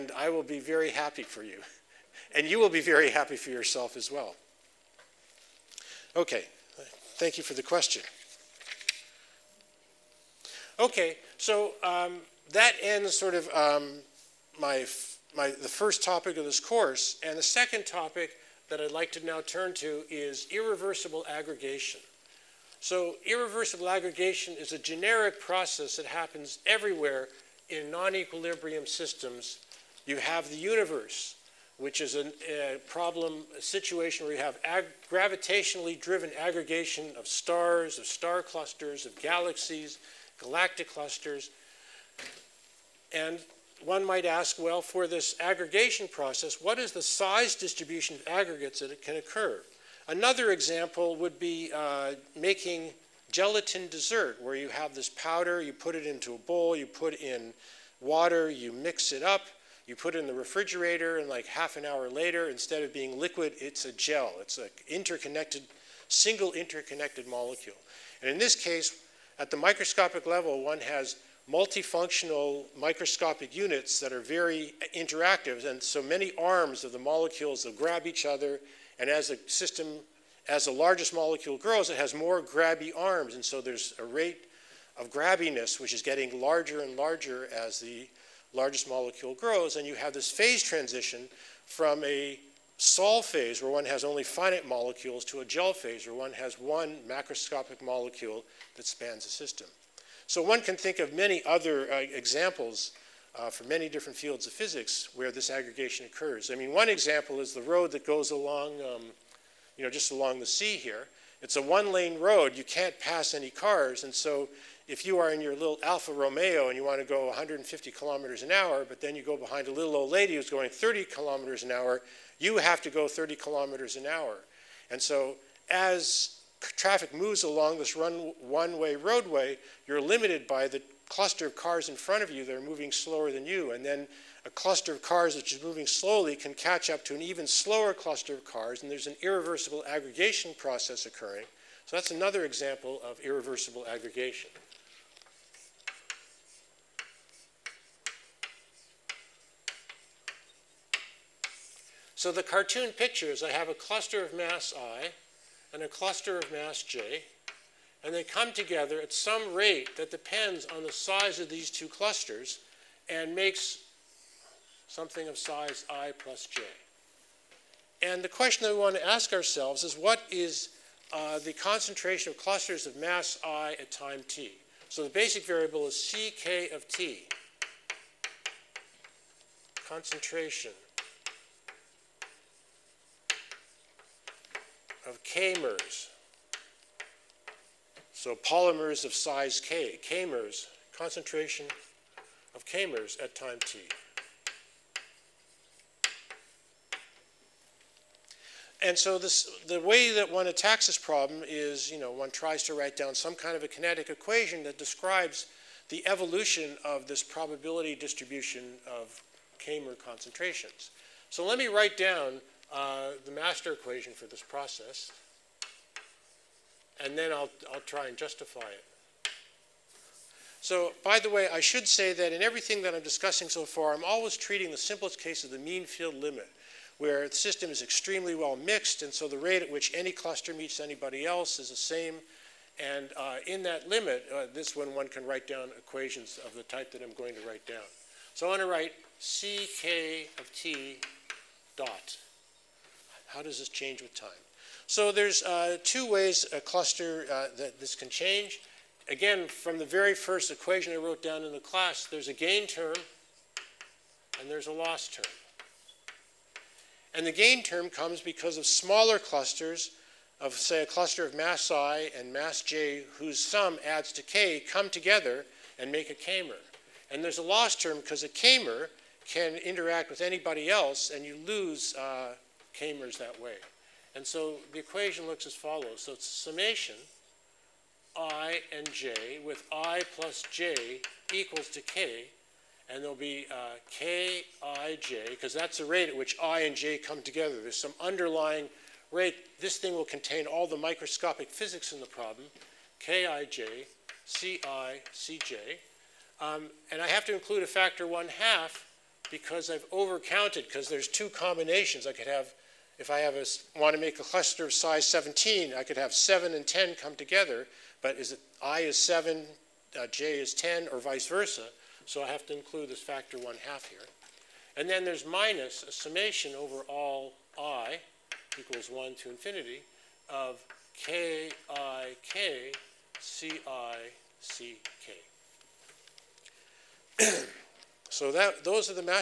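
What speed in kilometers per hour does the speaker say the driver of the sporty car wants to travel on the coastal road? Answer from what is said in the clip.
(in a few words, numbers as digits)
150.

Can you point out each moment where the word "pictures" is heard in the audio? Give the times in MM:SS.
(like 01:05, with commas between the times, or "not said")
02:32.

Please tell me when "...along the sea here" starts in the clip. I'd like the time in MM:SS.
01:50.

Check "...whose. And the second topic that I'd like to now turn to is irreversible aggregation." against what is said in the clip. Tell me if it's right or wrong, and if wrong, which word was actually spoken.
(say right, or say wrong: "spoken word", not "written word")
wrong: "course", not "whose".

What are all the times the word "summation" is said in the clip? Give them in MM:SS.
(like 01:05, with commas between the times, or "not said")
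04:36, 05:15.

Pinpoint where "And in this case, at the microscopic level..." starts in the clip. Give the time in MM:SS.
01:08.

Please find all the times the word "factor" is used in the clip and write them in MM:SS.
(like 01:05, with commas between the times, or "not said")
04:57, 05:13.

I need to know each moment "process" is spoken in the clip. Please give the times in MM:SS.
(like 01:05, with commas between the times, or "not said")
00:25, 00:46, 02:20, 03:34.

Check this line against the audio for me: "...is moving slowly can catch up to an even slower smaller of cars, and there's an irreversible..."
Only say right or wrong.
wrong.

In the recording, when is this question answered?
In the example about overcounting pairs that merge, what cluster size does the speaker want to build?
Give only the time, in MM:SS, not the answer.
05:05.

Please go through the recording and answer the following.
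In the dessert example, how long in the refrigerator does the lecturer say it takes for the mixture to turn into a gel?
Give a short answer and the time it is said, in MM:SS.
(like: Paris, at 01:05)
half an hour, at 01:01.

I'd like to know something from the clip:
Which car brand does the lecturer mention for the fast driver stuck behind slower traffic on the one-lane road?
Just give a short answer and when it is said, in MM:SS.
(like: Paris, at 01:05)
Alfa Romeo, at 01:55.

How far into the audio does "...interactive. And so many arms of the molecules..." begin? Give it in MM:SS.
01:14.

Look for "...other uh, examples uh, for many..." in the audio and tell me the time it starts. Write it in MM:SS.
01:41.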